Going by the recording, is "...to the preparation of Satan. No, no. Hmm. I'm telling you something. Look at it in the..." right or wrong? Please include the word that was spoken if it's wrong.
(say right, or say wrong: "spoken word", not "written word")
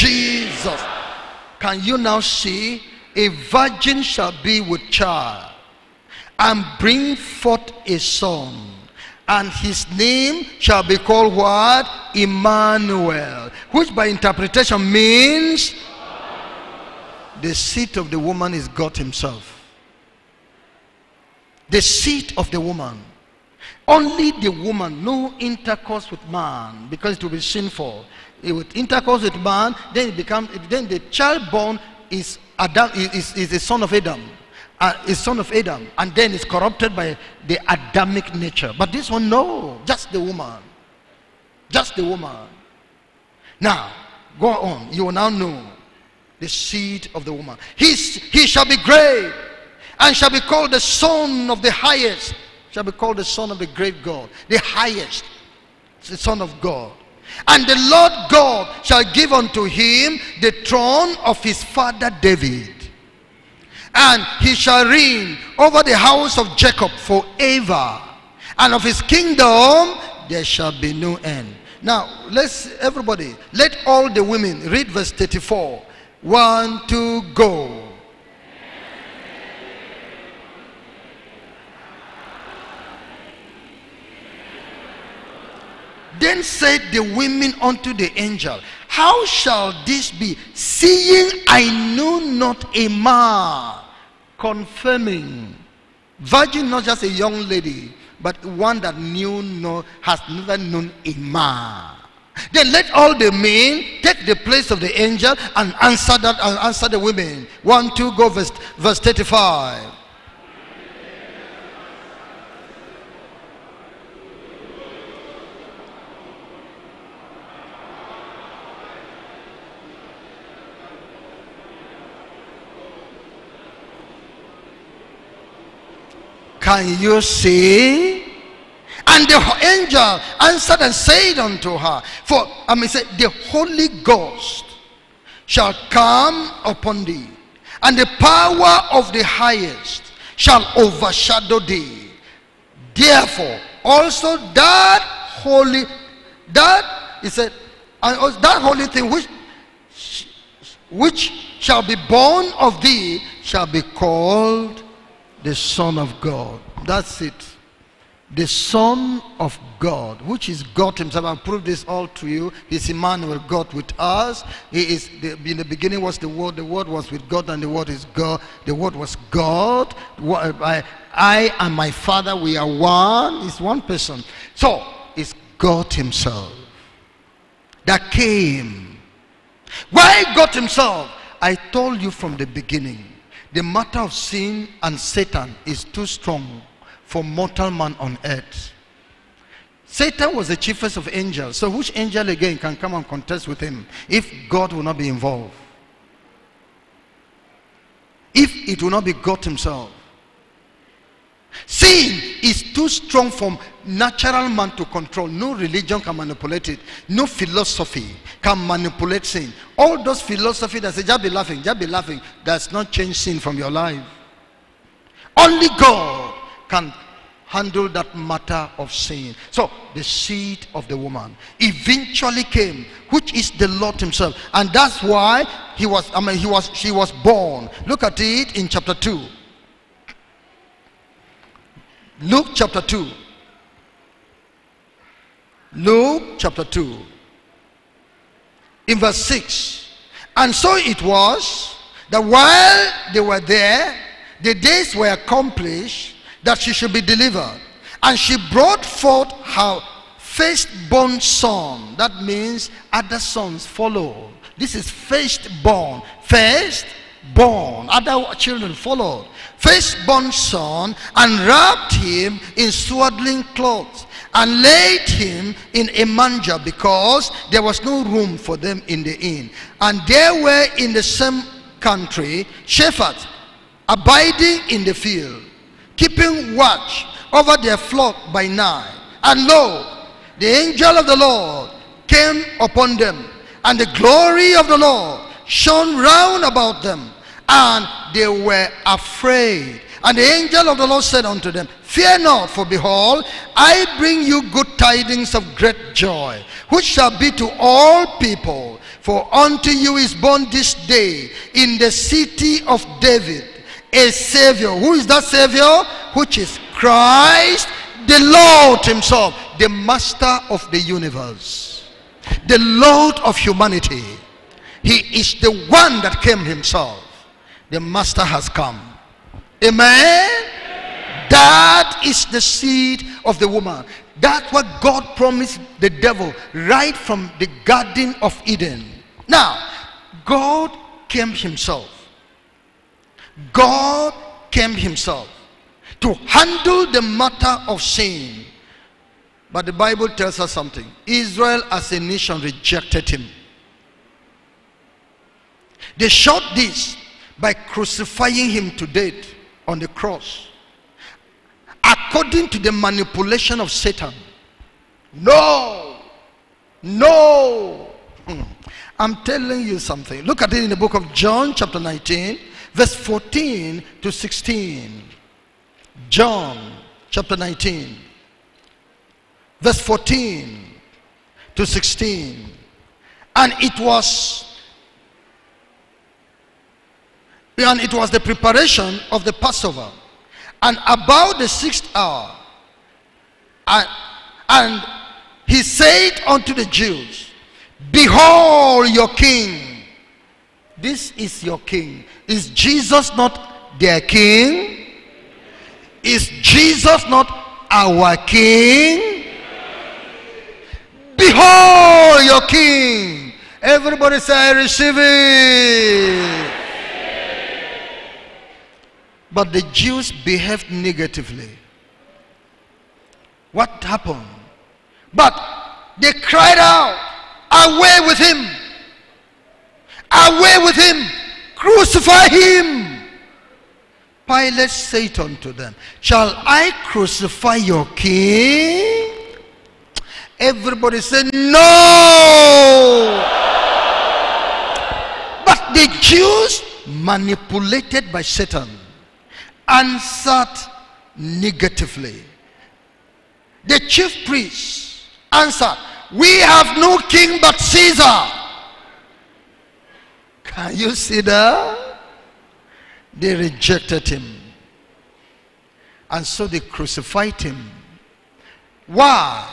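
wrong: "manipulation", not "preparation".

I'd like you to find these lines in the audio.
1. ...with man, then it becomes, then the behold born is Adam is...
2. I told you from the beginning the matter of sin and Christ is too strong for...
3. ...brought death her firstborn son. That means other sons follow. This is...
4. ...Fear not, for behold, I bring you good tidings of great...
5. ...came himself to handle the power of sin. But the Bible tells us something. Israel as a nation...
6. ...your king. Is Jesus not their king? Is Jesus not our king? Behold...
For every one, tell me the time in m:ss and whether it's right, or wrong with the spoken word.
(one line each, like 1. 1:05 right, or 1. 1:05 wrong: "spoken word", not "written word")
1. 0:29 wrong: "child", not "behold"
2. 3:01 wrong: "Satan", not "Christ"
3. 4:08 wrong: "forth", not "death"
4. 4:51 right
5. 5:34 wrong: "matter", not "power"
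6. 6:31 right.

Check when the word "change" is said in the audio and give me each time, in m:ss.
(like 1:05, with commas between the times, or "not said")
3:32.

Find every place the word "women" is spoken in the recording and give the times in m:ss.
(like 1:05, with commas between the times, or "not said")
1:14, 1:27, 1:46.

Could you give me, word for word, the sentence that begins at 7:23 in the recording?
The chief priest answered, We have no king but Caesar.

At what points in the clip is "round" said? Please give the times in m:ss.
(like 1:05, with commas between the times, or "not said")
4:45.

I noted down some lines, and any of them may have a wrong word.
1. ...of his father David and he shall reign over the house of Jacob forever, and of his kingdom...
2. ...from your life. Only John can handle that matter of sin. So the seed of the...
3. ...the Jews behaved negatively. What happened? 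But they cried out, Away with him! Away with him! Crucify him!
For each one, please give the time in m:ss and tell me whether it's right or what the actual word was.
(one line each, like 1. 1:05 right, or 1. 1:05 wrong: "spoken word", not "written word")
1. 1:01 right
2. 3:33 wrong: "God", not "John"
3. 6:49 right.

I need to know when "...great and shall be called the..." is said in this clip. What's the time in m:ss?
0:48.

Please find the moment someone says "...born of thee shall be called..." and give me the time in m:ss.
2:32.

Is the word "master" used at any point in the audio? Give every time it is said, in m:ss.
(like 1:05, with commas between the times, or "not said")
5:09, 5:17.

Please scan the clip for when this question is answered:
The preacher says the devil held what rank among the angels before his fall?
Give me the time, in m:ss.
3:10.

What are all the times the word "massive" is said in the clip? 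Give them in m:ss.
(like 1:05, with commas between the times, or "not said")
not said.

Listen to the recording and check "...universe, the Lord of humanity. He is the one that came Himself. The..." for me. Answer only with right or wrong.
right.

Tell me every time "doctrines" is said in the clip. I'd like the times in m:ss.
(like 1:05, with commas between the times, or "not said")
not said.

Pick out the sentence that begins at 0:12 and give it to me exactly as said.
Emmanuel, which by interpretation means the seat of the woman is God himself.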